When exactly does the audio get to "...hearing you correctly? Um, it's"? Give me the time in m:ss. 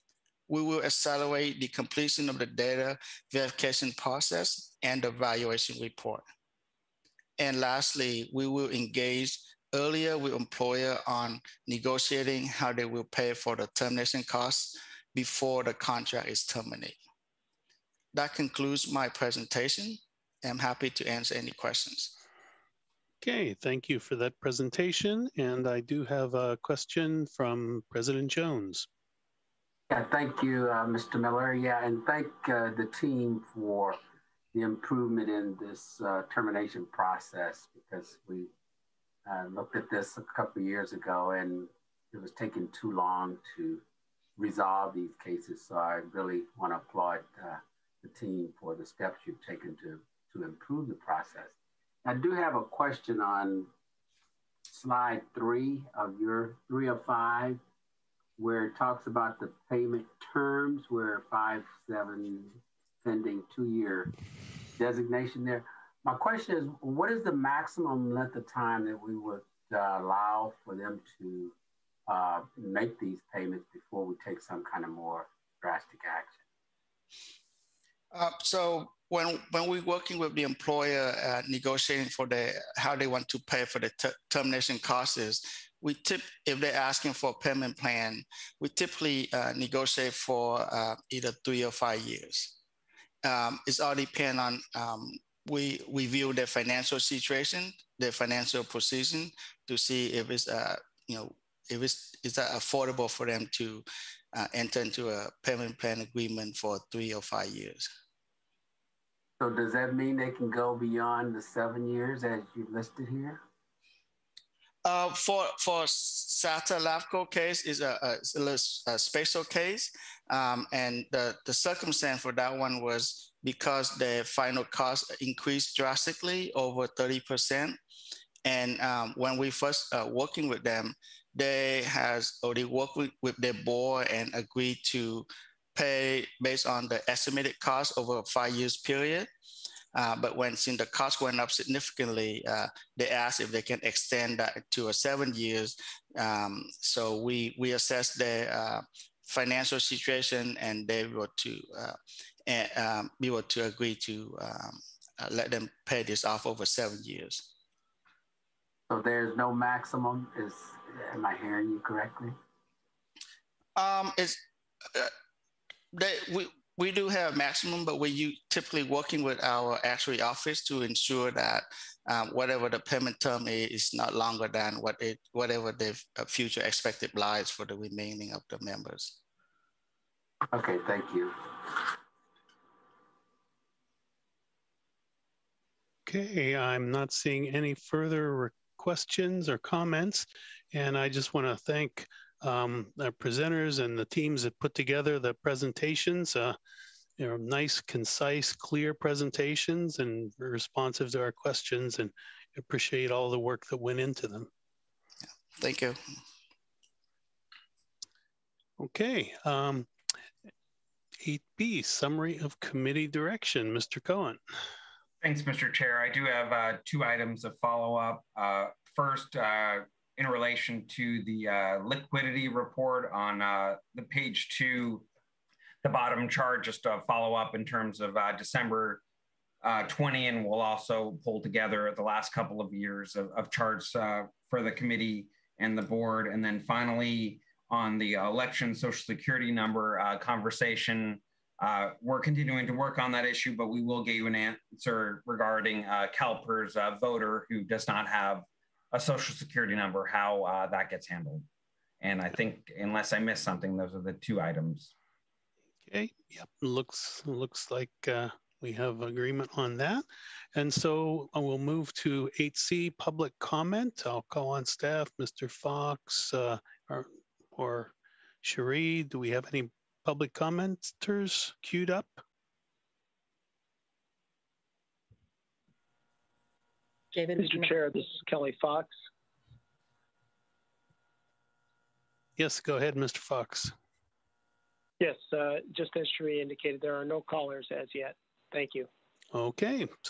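2:41.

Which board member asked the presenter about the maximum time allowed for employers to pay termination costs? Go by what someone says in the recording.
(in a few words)
President Jones.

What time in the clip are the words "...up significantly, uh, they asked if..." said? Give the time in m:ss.
2:21.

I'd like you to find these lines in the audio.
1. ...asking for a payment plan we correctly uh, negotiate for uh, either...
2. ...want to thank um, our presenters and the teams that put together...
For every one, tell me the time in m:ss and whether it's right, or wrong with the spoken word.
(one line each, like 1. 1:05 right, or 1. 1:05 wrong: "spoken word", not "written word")
1. 1:26 wrong: "typically", not "correctly"
2. 3:11 right.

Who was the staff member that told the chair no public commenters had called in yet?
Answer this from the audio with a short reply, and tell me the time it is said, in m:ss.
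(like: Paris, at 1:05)
Kelly Fox, at 4:38.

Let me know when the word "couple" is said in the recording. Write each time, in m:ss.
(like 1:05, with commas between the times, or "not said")
0:40, 3:52.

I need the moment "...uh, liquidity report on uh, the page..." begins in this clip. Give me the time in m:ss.
3:41.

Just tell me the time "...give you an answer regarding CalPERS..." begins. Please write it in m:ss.
4:04.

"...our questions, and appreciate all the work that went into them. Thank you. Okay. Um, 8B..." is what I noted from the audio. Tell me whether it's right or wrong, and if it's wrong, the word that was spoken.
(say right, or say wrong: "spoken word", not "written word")
right.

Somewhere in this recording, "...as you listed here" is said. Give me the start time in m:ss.
1:52.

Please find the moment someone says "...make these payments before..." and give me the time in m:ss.
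1:12.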